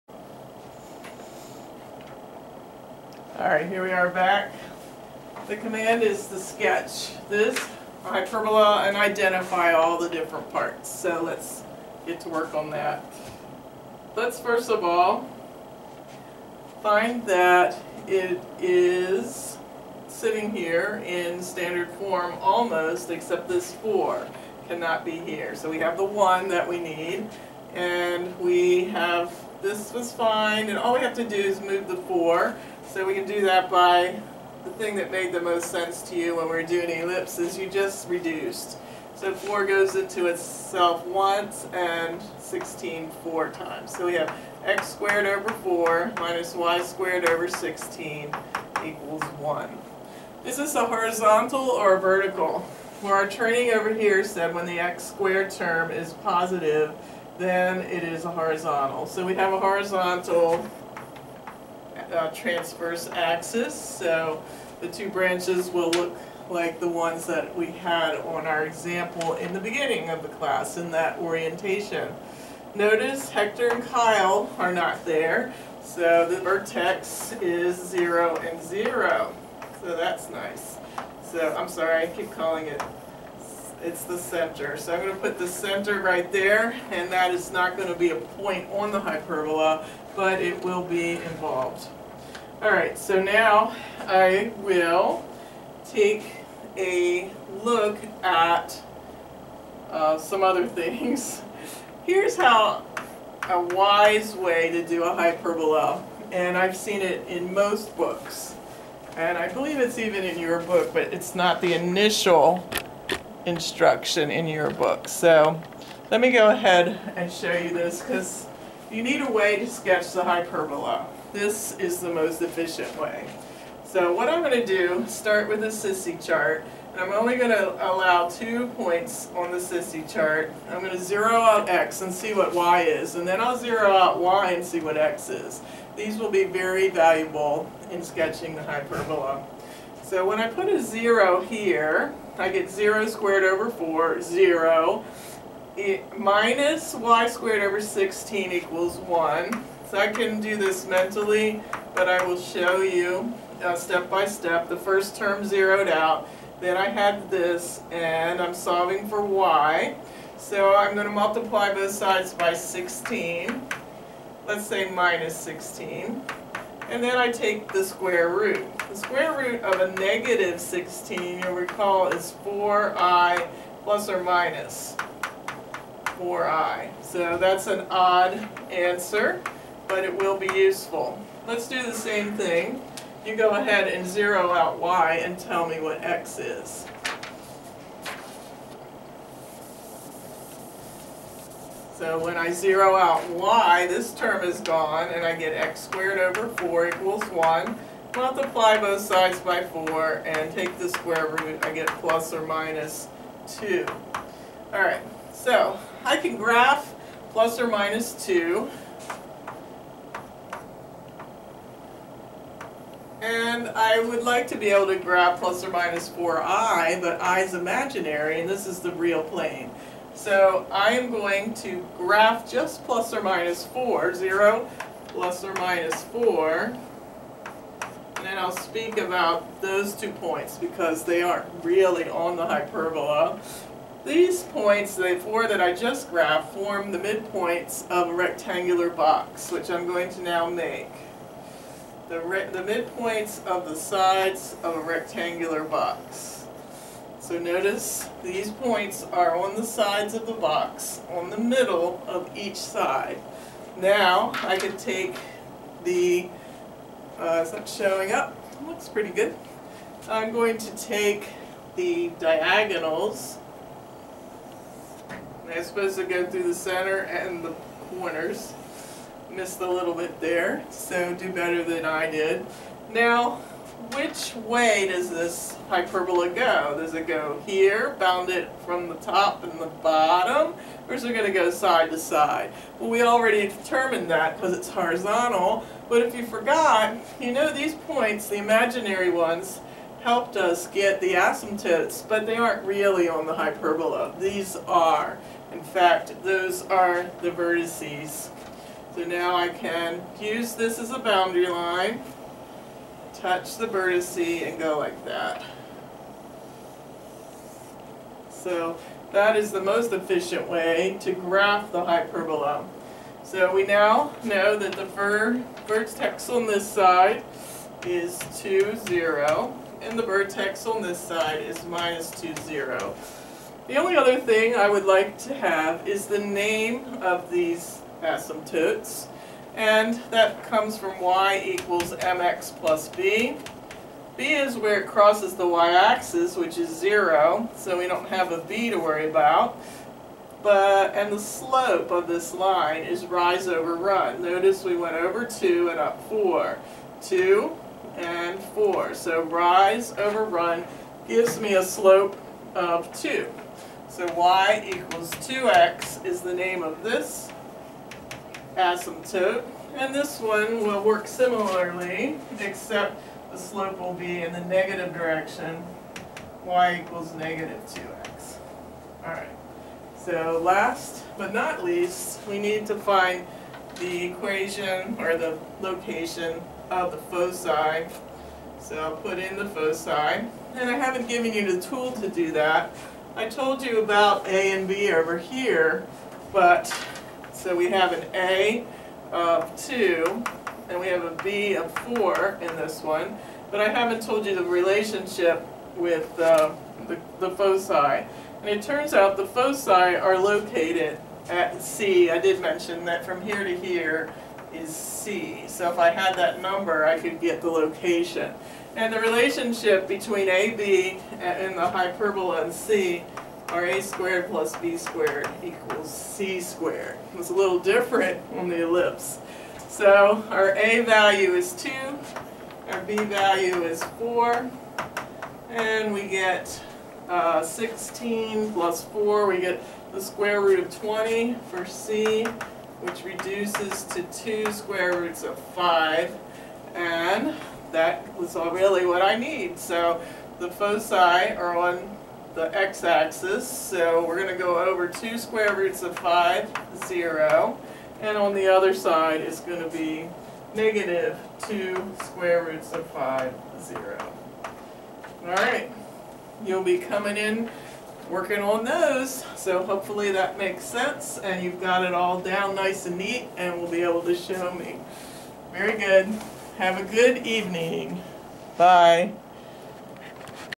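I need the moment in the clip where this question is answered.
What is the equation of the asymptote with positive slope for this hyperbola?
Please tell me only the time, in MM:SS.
05:54.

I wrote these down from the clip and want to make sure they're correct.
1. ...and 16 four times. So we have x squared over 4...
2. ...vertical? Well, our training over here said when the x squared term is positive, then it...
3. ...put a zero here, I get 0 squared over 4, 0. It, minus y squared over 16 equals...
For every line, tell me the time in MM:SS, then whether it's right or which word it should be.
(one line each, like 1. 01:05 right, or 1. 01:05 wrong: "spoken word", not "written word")
1. 00:41 right
2. 00:52 right
3. 02:20 right.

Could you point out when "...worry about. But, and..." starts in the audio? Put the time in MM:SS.
05:38.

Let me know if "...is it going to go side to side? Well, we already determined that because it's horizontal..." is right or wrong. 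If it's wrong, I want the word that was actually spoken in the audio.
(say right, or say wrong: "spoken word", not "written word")
right.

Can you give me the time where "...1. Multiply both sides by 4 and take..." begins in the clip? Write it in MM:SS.
03:17.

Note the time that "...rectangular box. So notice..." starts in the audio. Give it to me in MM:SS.
04:04.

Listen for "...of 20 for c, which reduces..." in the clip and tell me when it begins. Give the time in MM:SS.
07:10.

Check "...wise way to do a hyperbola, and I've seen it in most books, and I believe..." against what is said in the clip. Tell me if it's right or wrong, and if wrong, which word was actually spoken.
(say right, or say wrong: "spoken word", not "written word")
right.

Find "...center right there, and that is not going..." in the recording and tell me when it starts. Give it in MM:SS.
01:25.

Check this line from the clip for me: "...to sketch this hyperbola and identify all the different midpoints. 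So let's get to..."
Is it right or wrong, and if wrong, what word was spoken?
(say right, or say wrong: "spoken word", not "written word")
wrong: "parts", not "midpoints".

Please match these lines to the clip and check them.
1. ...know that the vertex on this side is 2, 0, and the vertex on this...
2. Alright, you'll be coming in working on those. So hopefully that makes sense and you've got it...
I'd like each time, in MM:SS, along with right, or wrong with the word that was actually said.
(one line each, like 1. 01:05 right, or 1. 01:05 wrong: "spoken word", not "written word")
1. 05:14 right
2. 07:35 right.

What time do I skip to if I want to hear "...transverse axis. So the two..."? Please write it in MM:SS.
01:02.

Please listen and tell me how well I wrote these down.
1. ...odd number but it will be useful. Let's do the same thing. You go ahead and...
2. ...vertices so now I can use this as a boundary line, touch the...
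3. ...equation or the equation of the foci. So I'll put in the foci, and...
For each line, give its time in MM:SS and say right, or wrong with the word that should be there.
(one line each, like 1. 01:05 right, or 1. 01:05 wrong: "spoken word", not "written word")
1. 02:57 wrong: "answer", not "number"
2. 04:57 right
3. 06:14 wrong: "location", not "equation".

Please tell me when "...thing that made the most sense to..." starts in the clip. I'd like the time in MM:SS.
00:34.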